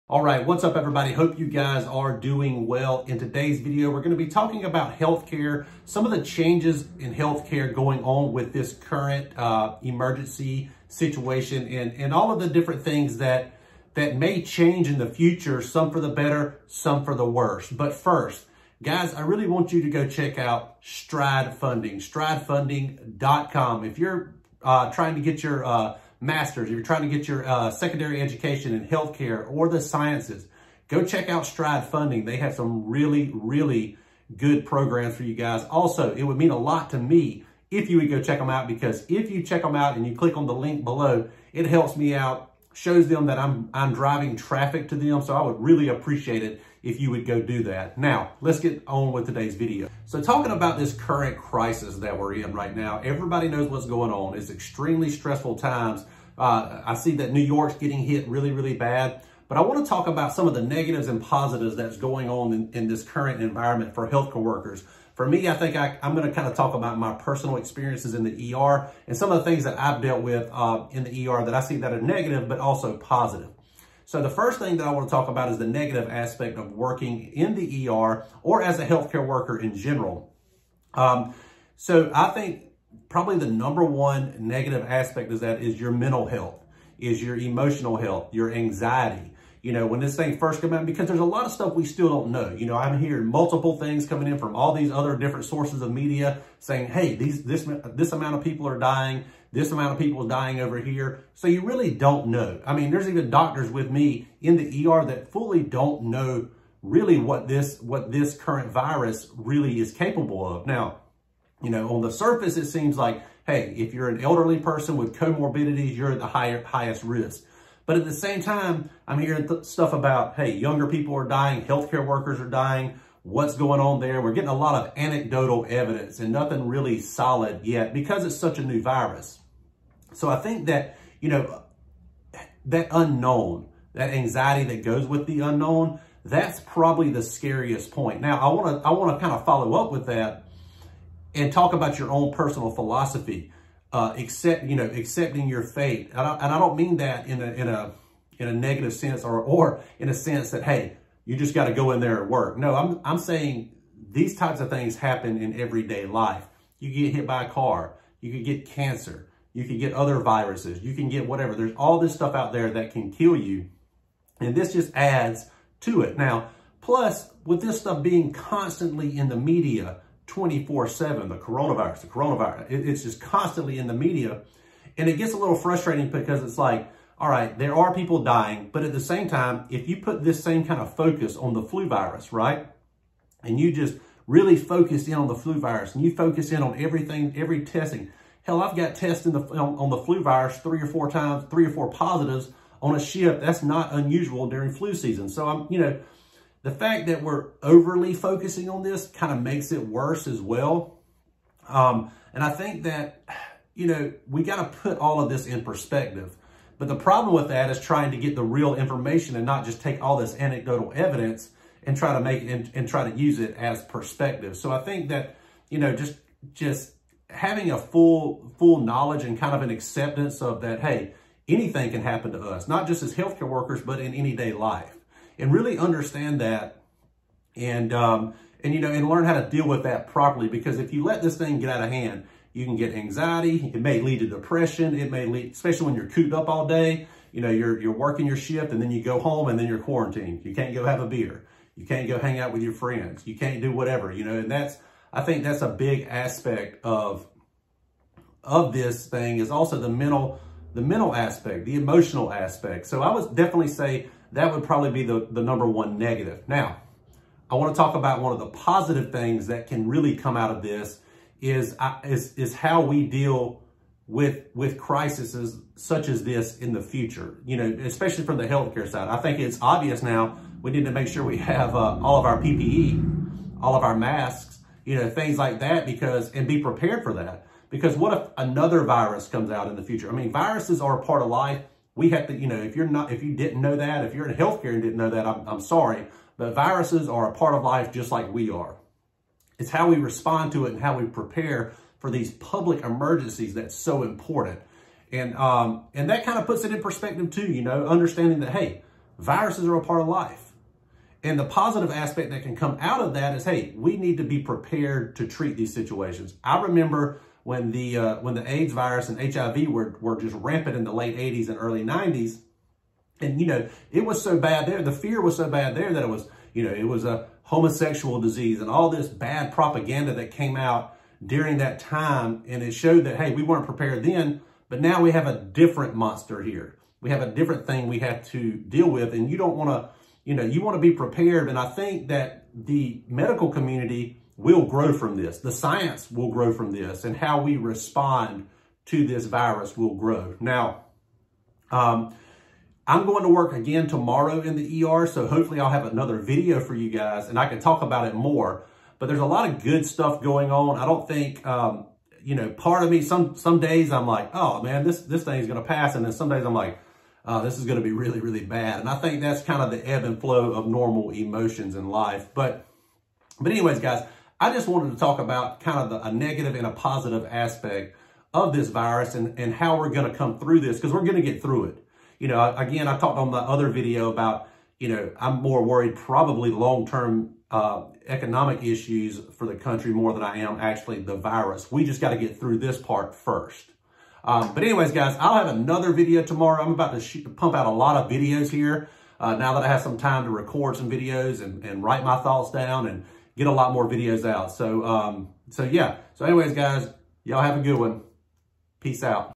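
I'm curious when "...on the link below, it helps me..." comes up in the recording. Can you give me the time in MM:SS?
00:40.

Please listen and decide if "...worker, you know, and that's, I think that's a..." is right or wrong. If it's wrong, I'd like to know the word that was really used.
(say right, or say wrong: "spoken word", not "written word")
wrong: "whatever", not "worker".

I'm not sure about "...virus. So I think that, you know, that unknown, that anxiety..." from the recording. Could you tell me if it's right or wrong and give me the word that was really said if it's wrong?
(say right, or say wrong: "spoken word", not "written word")
right.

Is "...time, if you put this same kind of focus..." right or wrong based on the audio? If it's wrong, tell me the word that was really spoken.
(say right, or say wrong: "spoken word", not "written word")
right.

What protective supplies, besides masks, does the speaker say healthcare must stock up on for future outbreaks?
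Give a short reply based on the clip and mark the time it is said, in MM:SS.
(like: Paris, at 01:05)
PPE, at 04:32.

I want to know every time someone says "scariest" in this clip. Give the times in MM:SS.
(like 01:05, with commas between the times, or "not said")
02:17.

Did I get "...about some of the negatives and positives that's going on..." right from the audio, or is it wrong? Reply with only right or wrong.
right.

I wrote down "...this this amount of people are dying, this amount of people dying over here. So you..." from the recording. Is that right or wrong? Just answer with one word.
right.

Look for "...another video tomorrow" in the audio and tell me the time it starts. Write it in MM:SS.
06:25.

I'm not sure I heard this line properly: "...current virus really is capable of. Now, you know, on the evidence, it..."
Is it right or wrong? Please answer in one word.
wrong.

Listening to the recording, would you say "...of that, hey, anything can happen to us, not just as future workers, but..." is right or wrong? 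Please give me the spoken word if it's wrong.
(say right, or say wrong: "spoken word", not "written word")
wrong: "healthcare", not "future".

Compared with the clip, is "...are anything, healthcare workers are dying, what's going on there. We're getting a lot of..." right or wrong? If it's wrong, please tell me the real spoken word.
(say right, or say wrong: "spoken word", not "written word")
wrong: "dying", not "anything".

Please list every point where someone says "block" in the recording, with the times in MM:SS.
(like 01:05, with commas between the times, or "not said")
not said.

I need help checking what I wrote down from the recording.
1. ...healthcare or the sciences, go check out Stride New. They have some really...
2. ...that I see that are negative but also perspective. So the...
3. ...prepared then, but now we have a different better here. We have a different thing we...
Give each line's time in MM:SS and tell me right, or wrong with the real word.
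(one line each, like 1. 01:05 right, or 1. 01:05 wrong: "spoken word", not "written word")
1. 00:28 wrong: "Funding", not "New"
2. 01:11 wrong: "positive", not "perspective"
3. 05:23 wrong: "monster", not "better".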